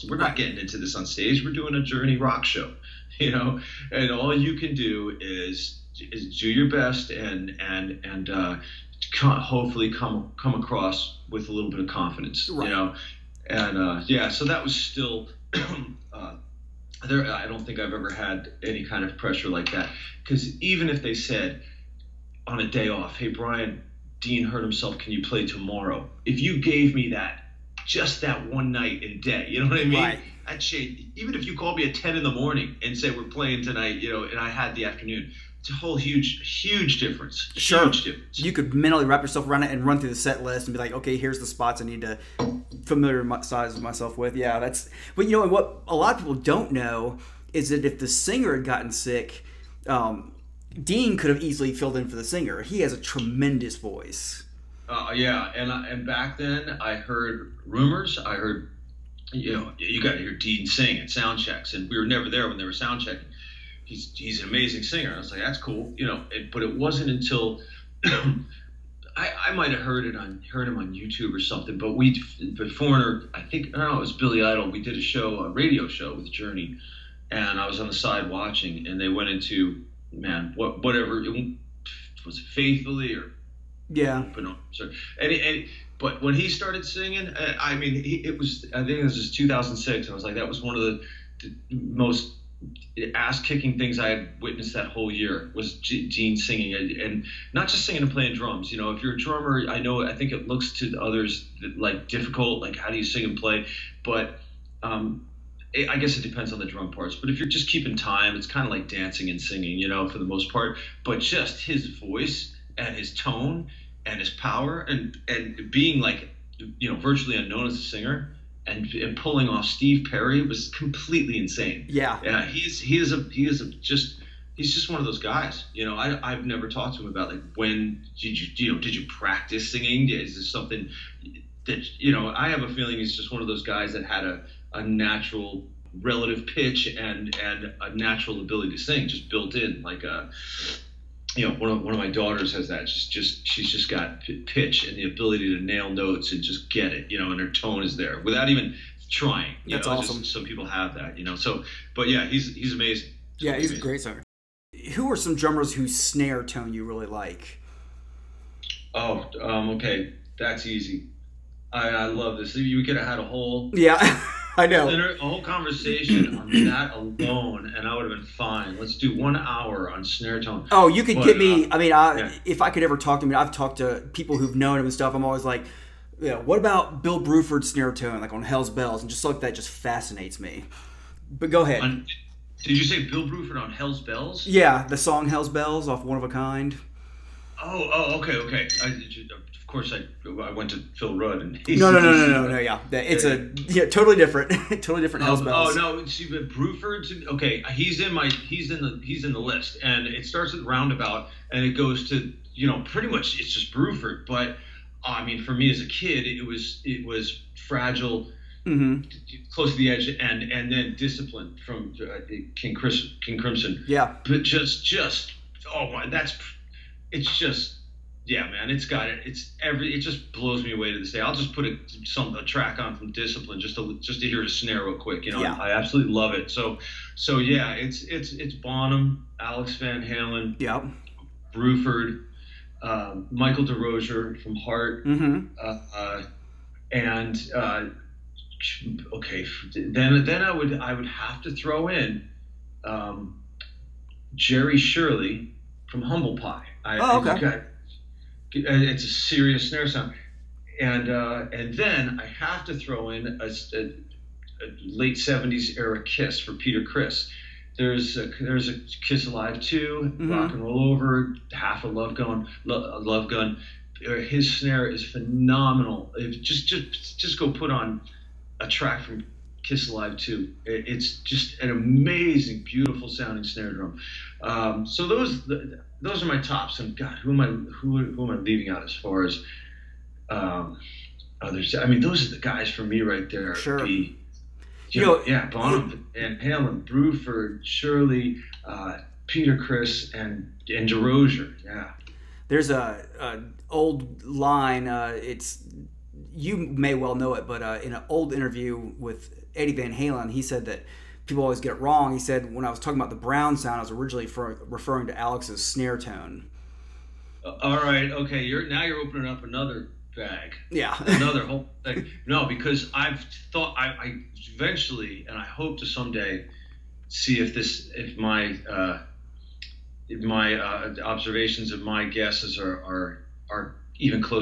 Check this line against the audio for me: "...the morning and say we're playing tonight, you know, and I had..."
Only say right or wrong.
right.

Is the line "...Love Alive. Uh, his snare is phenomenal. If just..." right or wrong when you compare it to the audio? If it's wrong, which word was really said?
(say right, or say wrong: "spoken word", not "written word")
wrong: "Gun", not "Alive".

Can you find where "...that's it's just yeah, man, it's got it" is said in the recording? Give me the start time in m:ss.
3:36.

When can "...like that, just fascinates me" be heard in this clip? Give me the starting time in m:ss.
2:59.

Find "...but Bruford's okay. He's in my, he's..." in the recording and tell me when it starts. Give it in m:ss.
3:16.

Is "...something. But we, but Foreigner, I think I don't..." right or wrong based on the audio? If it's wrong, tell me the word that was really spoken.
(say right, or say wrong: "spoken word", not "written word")
right.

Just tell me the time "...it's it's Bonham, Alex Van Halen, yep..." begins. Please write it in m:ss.
3:48.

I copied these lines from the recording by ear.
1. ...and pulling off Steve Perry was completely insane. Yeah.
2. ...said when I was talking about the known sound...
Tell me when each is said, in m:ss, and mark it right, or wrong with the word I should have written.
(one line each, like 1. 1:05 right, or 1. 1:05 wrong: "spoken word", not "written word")
1. 1:58 right
2. 5:02 wrong: "brown", not "known".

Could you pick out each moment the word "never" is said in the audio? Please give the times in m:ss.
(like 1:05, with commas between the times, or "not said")
1:02, 2:06.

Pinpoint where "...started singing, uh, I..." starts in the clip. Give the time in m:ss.
1:26.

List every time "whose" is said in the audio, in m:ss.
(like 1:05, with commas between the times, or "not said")
2:35.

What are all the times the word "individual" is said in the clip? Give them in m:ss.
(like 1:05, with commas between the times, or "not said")
not said.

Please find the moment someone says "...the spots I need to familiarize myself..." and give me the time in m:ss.
0:41.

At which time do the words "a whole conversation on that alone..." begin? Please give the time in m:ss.
2:44.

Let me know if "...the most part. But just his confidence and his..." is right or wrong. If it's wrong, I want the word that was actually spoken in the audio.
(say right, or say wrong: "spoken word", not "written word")
wrong: "voice", not "confidence".